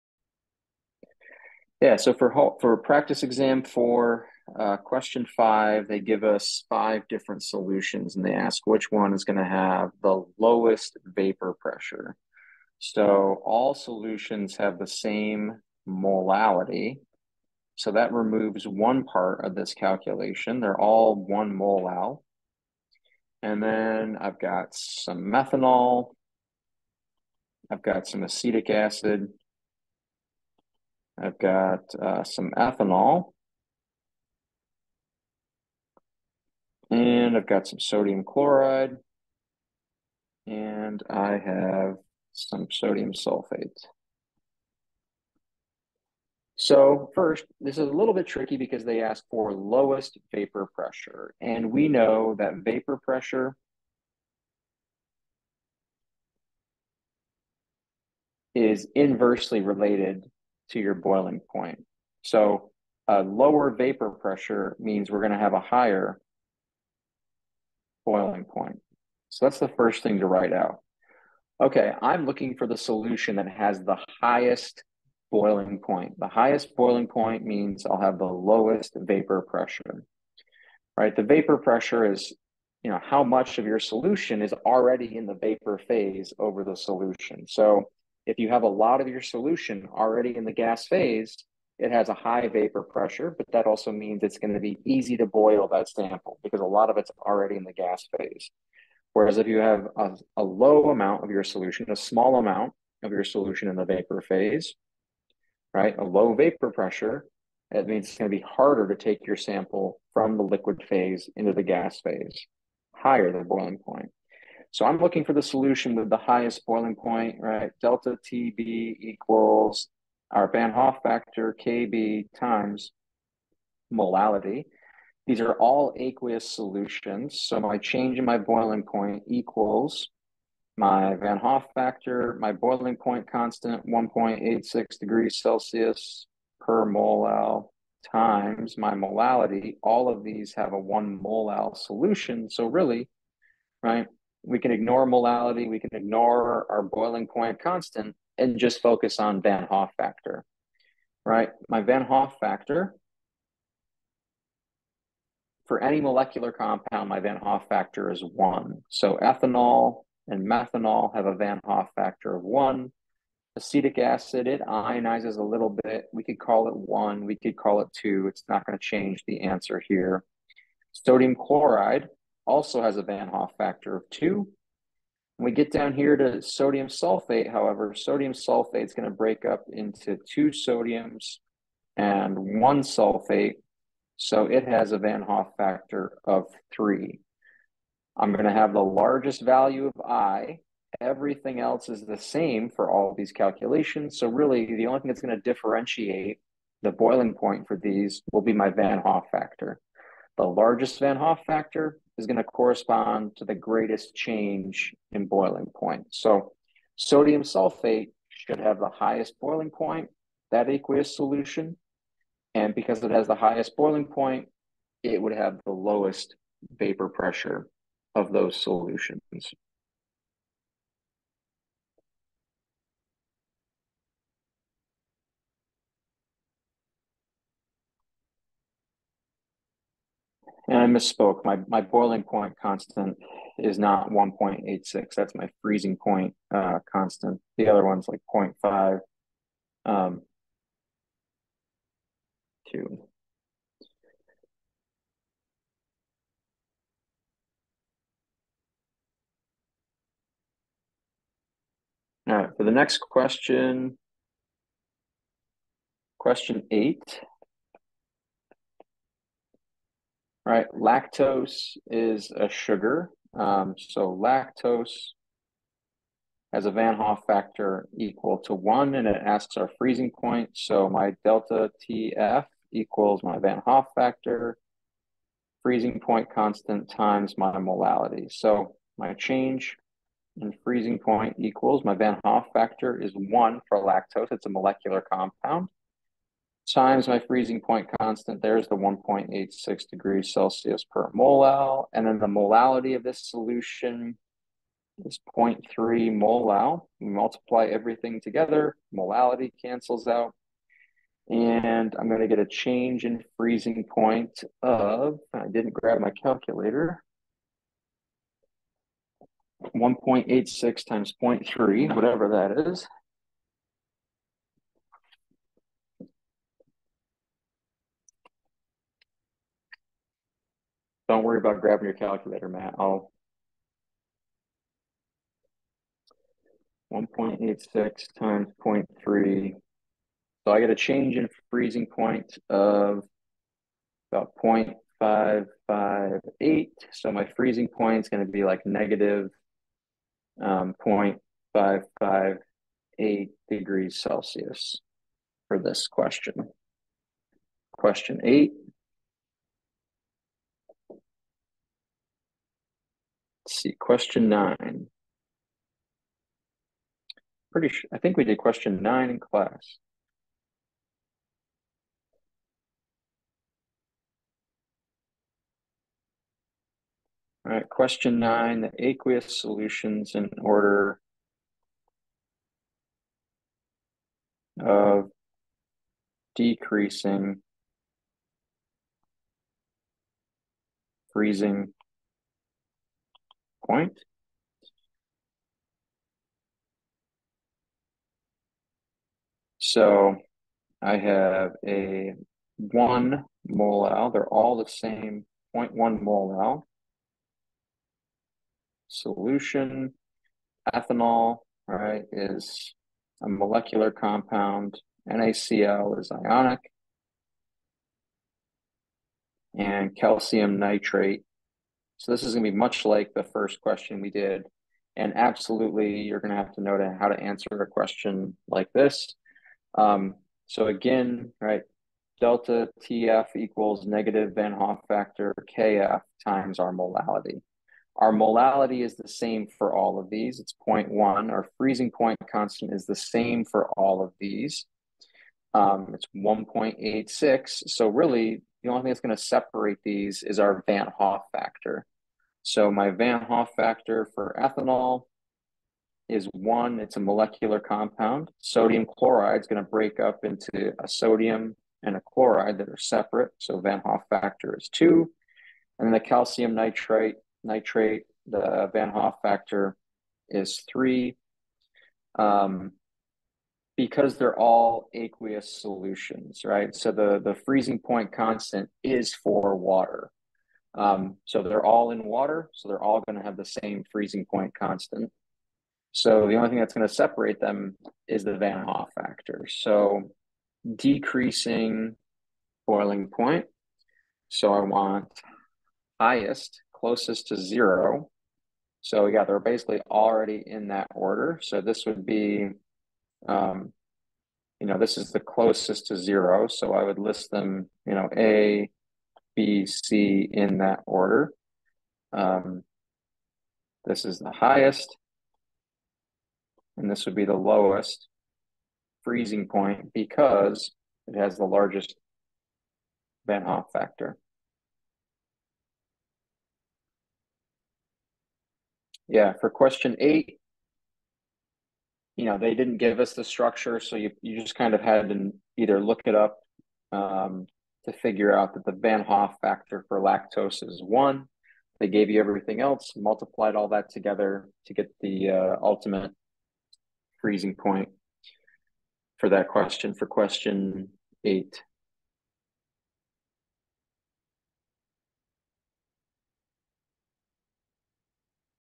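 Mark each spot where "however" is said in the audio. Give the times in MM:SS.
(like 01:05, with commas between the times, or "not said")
02:57.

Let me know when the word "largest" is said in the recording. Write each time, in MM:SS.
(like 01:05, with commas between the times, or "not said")
03:08, 03:20, 08:31.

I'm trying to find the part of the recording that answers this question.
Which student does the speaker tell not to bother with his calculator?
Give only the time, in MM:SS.
05:22.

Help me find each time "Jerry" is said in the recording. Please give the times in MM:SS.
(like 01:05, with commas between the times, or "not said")
not said.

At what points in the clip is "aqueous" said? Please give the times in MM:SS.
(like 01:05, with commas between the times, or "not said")
02:05, 03:30, 06:08, 07:44.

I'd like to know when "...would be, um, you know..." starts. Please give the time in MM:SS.
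08:11.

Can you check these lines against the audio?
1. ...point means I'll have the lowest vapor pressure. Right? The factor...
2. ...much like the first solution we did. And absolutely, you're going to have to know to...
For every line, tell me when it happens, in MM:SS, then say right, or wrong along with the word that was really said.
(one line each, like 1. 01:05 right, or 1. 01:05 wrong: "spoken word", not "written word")
1. 01:17 wrong: "vapor", not "factor"
2. 06:52 wrong: "question", not "solution".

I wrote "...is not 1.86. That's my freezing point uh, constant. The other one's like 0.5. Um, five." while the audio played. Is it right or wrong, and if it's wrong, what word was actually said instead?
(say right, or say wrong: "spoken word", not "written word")
wrong: "two", not "five".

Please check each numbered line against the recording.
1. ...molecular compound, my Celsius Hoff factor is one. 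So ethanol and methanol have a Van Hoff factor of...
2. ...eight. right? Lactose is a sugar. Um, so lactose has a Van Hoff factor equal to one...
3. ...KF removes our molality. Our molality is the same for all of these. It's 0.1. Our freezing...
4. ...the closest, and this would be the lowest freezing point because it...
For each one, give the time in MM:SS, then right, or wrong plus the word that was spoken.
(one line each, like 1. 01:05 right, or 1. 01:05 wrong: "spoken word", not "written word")
1. 02:36 wrong: "Van", not "Celsius"
2. 04:16 right
3. 07:05 wrong: "times", not "removes"
4. 08:24 wrong: "highest", not "closest".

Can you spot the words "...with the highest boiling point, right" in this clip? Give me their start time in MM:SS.
01:55.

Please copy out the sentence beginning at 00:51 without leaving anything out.
And we know that vapor pressure is inversely related to your boiling point.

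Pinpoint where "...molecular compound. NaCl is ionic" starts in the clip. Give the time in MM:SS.
06:43.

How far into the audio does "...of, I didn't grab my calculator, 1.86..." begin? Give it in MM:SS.
05:04.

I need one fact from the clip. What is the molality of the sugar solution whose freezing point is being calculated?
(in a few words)
0.3 molal.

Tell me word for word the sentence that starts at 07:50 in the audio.
Um, so they're all in water, so they're all going to have the same freezing point constant.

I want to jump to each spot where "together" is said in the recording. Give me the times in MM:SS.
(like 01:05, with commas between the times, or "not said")
04:58, 08:53.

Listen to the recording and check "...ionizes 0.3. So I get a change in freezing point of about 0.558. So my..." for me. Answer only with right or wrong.
wrong.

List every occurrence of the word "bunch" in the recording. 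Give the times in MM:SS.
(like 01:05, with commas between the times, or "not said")
not said.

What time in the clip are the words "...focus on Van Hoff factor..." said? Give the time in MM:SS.
02:28.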